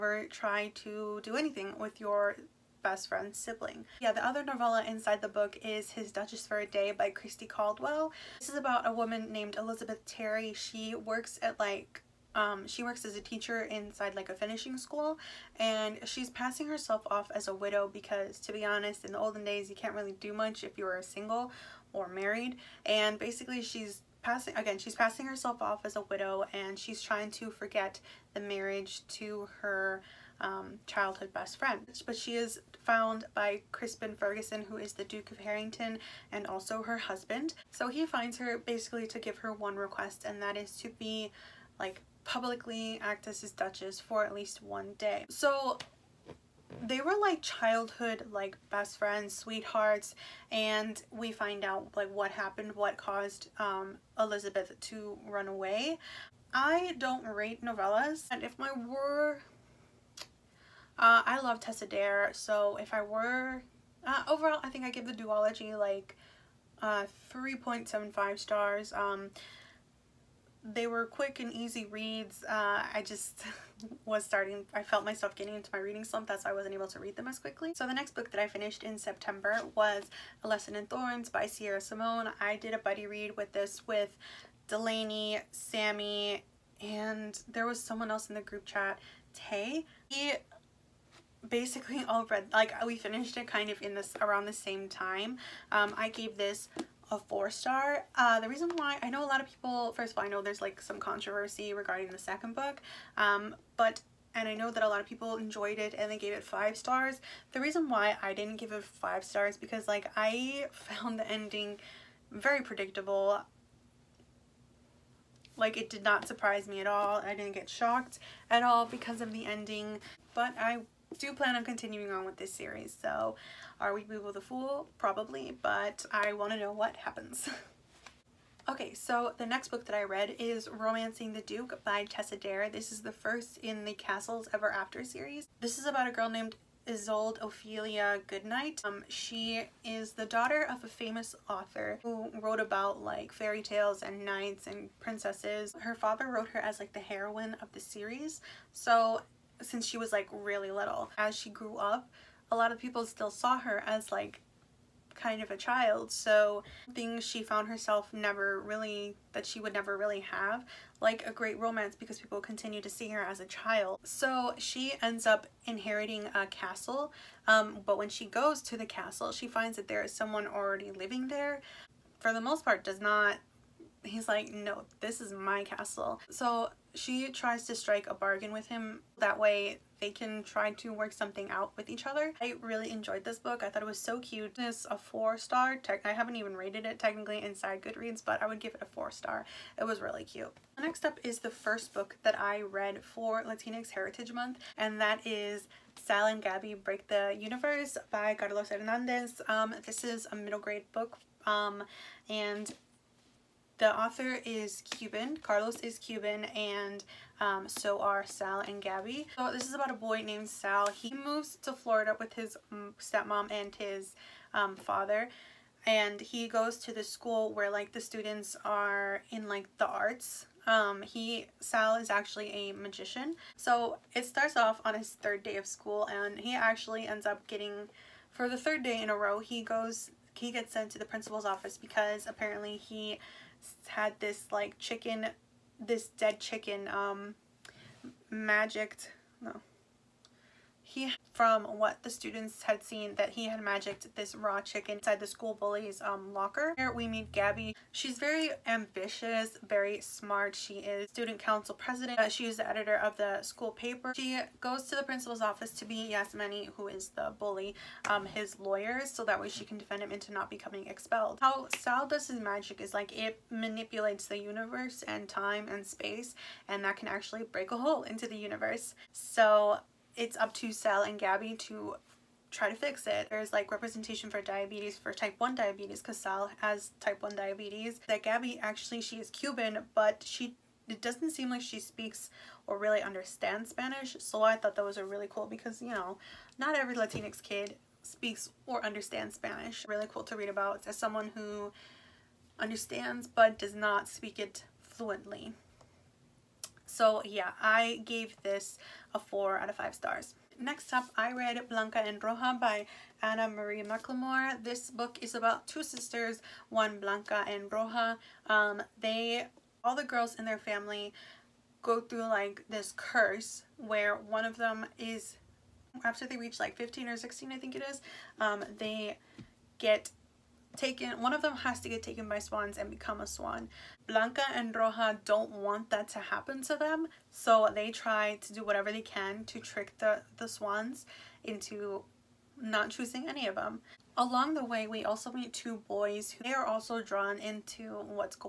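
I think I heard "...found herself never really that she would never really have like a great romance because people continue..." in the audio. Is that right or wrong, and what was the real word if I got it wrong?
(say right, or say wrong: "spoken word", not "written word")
right.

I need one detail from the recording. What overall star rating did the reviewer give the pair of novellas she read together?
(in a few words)
3.75 stars.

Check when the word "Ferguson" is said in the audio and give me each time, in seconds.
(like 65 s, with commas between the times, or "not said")
34 s.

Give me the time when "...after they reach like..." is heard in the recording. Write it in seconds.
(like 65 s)
316 s.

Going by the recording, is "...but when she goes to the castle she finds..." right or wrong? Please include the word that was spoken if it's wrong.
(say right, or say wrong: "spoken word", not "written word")
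right.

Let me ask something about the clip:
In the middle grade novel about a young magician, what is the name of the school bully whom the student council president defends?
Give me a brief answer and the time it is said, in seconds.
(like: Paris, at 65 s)
Yasmany, at 256 s.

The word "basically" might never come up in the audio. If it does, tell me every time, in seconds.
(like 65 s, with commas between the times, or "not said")
23 s, 38 s, 91 s.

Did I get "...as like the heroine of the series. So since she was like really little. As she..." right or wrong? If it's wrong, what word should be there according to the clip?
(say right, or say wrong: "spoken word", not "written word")
right.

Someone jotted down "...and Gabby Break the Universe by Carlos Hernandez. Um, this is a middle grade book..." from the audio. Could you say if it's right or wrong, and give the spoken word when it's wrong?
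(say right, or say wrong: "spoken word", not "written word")
right.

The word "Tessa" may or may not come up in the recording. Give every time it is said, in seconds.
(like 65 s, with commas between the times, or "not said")
61 s, 132 s.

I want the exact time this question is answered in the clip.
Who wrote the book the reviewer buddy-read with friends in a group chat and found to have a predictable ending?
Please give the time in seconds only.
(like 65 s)
81 s.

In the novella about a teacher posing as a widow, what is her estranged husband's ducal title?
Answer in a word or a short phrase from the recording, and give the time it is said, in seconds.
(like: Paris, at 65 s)
Duke of Harrington, at 35 s.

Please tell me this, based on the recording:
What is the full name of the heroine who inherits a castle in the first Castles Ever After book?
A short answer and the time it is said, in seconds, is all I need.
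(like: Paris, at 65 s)
Isolde Ophelia Goodnight, at 136 s.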